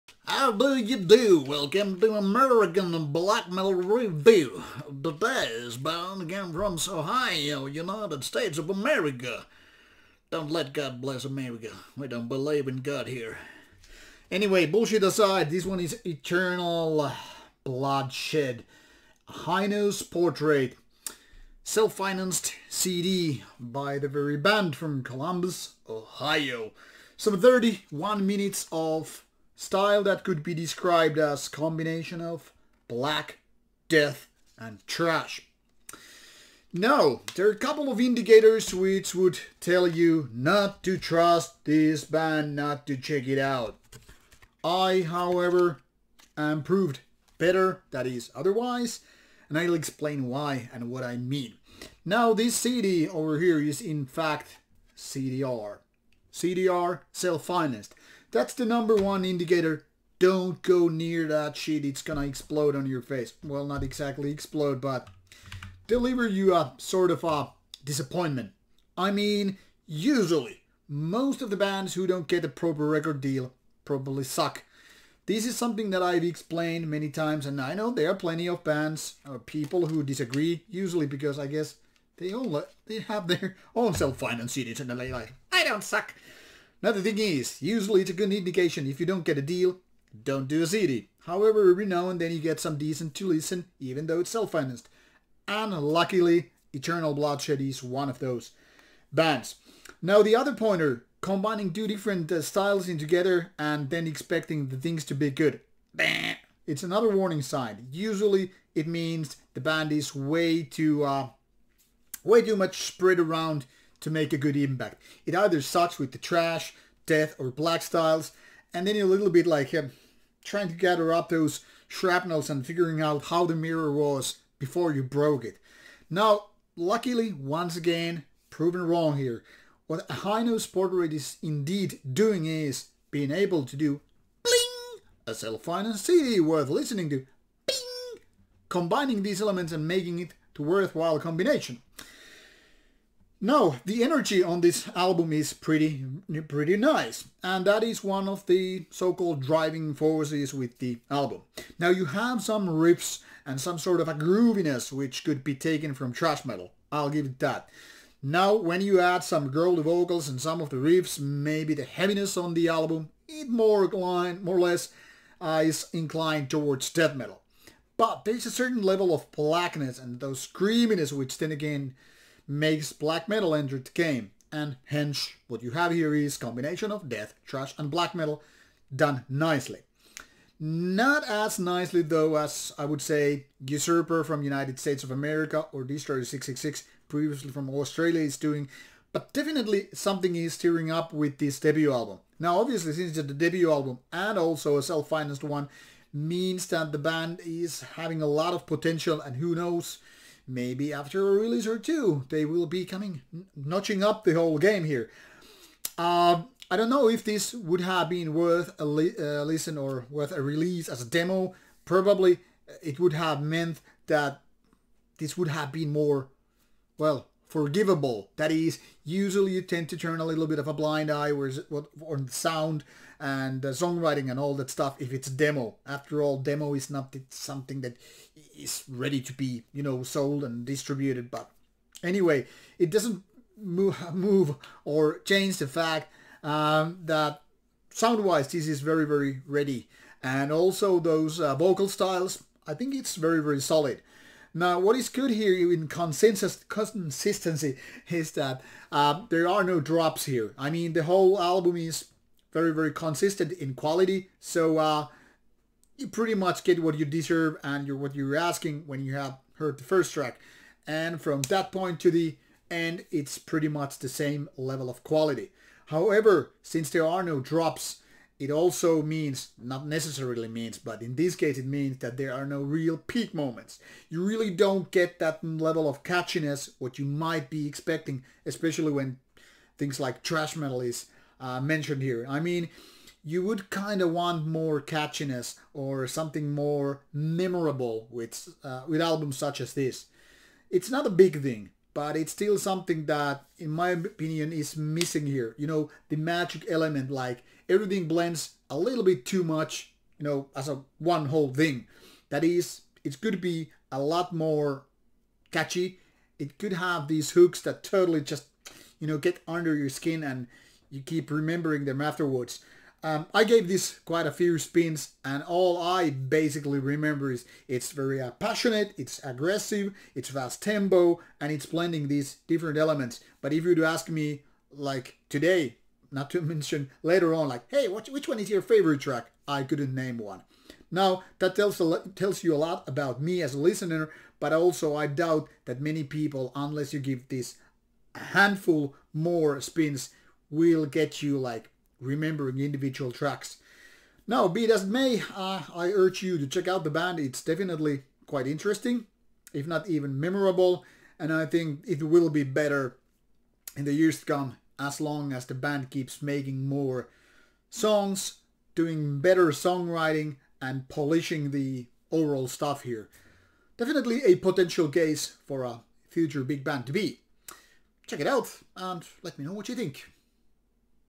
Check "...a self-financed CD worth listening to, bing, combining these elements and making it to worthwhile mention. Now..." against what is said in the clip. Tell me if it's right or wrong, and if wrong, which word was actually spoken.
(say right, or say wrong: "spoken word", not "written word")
wrong: "combination", not "mention".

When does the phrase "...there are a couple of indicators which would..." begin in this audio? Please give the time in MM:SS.
00:37.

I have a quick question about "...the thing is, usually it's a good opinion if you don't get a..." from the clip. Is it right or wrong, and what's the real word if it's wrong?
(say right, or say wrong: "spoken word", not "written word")
wrong: "indication", not "opinion".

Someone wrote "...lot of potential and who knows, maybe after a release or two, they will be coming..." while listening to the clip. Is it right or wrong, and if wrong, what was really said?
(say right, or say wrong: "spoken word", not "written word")
right.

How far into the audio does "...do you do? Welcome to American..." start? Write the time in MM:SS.
00:00.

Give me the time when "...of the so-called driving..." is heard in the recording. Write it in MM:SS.
02:28.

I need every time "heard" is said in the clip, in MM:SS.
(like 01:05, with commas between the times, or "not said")
04:19.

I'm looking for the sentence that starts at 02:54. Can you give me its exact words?
And hence, what you have here is combination of death, thrash and black metal done nicely.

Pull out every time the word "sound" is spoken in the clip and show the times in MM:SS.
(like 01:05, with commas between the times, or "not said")
03:42, 03:57.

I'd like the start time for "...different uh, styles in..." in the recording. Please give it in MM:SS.
01:41.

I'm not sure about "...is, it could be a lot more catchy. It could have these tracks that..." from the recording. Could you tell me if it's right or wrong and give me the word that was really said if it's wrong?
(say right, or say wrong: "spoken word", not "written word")
wrong: "hooks", not "tracks".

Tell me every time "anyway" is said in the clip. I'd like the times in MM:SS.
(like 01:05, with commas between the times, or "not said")
00:14, 03:52.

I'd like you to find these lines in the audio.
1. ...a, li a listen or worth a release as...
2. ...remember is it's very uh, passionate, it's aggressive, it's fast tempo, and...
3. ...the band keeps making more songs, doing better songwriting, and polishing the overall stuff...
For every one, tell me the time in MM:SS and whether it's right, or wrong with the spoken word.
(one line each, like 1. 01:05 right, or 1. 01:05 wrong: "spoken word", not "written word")
1. 03:28 right
2. 05:16 right
3. 05:55 right.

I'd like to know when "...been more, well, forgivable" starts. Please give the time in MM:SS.
03:35.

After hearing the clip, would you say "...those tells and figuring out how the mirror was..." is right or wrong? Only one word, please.
wrong.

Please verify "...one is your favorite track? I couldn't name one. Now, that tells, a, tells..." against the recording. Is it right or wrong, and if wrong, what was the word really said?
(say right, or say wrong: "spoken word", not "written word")
right.